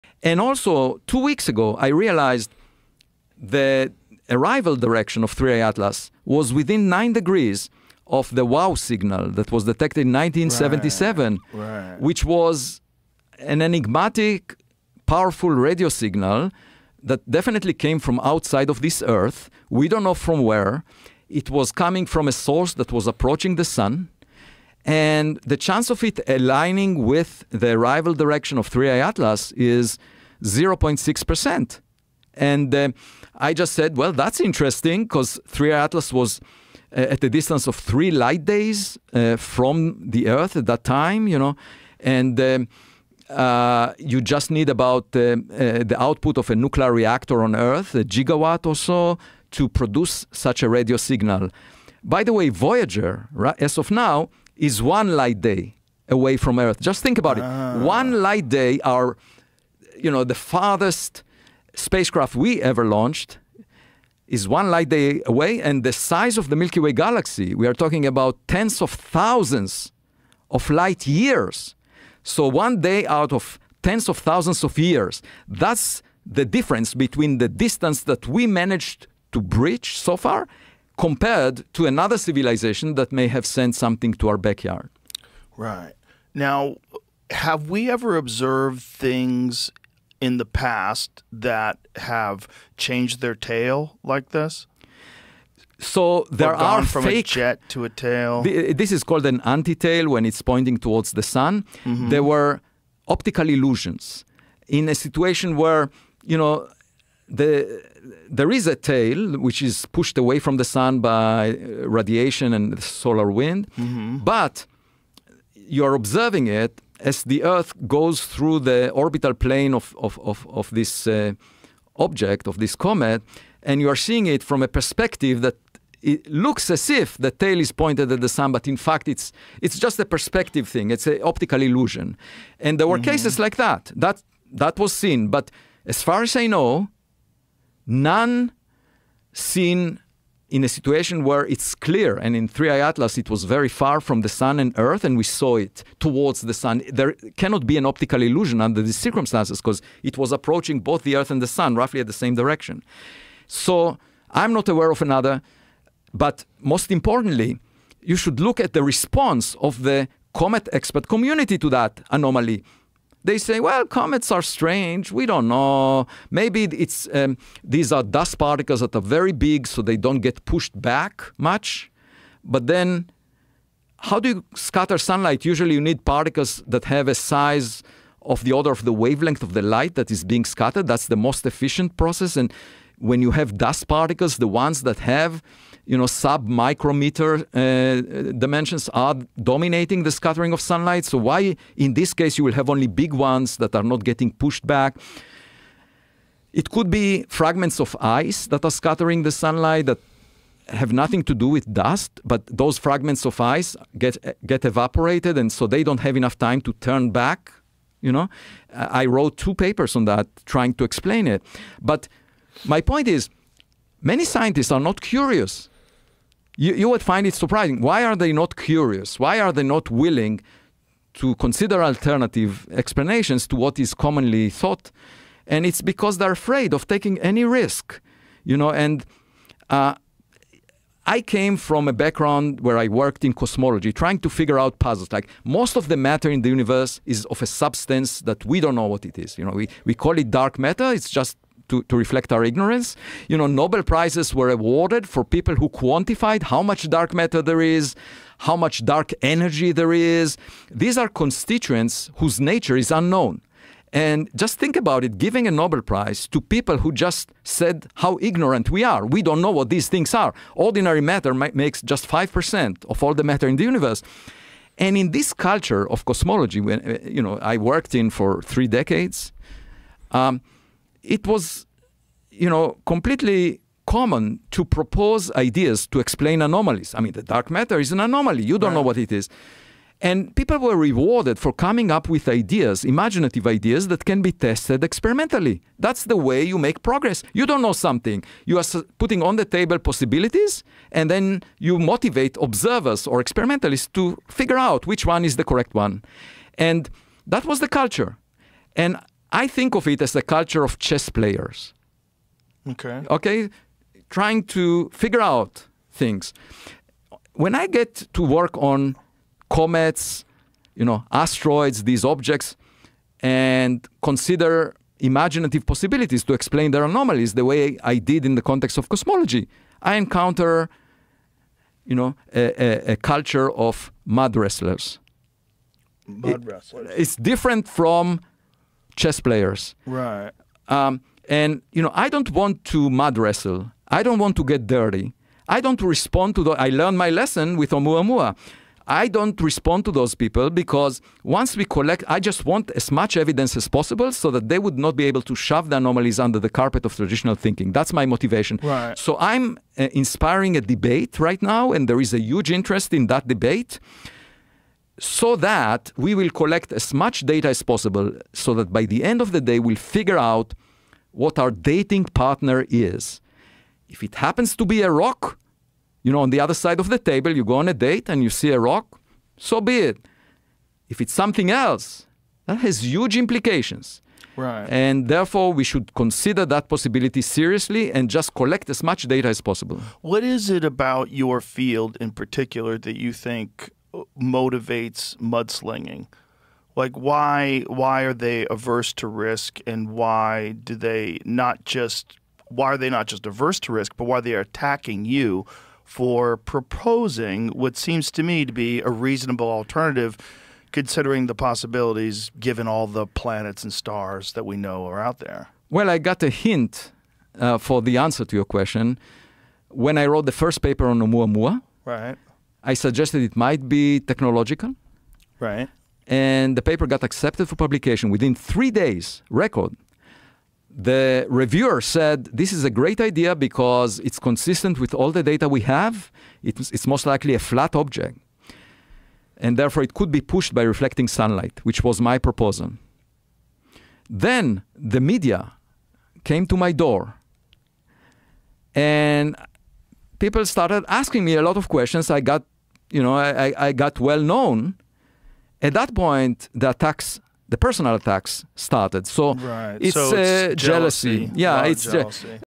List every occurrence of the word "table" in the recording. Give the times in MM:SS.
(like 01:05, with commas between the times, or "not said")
04:49, 06:06.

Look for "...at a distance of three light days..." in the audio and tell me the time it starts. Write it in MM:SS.
00:37.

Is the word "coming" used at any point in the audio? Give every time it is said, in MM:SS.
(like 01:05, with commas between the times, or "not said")
00:21, 04:41.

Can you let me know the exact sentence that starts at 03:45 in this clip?
And it's because they're afraid of taking any risk, you know.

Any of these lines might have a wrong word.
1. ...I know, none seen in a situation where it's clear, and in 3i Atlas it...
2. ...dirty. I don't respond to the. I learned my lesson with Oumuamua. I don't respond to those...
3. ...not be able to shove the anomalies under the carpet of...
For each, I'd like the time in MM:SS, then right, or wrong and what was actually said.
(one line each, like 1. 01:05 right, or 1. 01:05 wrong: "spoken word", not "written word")
1. 02:16 right
2. 05:34 right
3. 05:44 right.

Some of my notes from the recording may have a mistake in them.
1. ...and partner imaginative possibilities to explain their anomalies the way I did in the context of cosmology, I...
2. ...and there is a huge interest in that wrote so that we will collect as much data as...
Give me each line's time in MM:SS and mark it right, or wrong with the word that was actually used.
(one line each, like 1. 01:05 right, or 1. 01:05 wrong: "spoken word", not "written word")
1. 05:13 wrong: "consider", not "partner"
2. 05:51 wrong: "debate", not "wrote".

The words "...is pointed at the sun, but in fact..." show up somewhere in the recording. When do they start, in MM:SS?
02:07.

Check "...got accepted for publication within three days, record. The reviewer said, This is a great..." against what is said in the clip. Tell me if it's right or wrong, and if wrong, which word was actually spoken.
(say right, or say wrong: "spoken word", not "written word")
right.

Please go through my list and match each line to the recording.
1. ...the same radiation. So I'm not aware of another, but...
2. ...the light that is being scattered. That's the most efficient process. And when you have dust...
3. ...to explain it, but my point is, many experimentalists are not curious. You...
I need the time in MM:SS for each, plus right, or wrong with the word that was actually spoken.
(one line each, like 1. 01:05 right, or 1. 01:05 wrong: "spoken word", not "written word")
1. 02:32 wrong: "direction", not "radiation"
2. 02:59 right
3. 03:30 wrong: "scientists", not "experimentalists".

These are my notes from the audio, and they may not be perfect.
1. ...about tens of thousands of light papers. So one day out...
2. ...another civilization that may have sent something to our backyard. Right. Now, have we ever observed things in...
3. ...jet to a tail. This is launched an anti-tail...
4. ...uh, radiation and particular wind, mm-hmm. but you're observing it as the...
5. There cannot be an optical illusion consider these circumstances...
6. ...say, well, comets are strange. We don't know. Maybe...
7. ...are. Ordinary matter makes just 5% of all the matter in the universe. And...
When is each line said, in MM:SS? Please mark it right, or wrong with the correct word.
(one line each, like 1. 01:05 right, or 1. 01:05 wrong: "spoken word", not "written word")
1. 01:08 wrong: "years", not "papers"
2. 01:21 right
3. 01:37 wrong: "called", not "launched"
4. 01:51 wrong: "solar", not "particular"
5. 02:26 wrong: "under", not "consider"
6. 02:43 right
7. 04:20 right.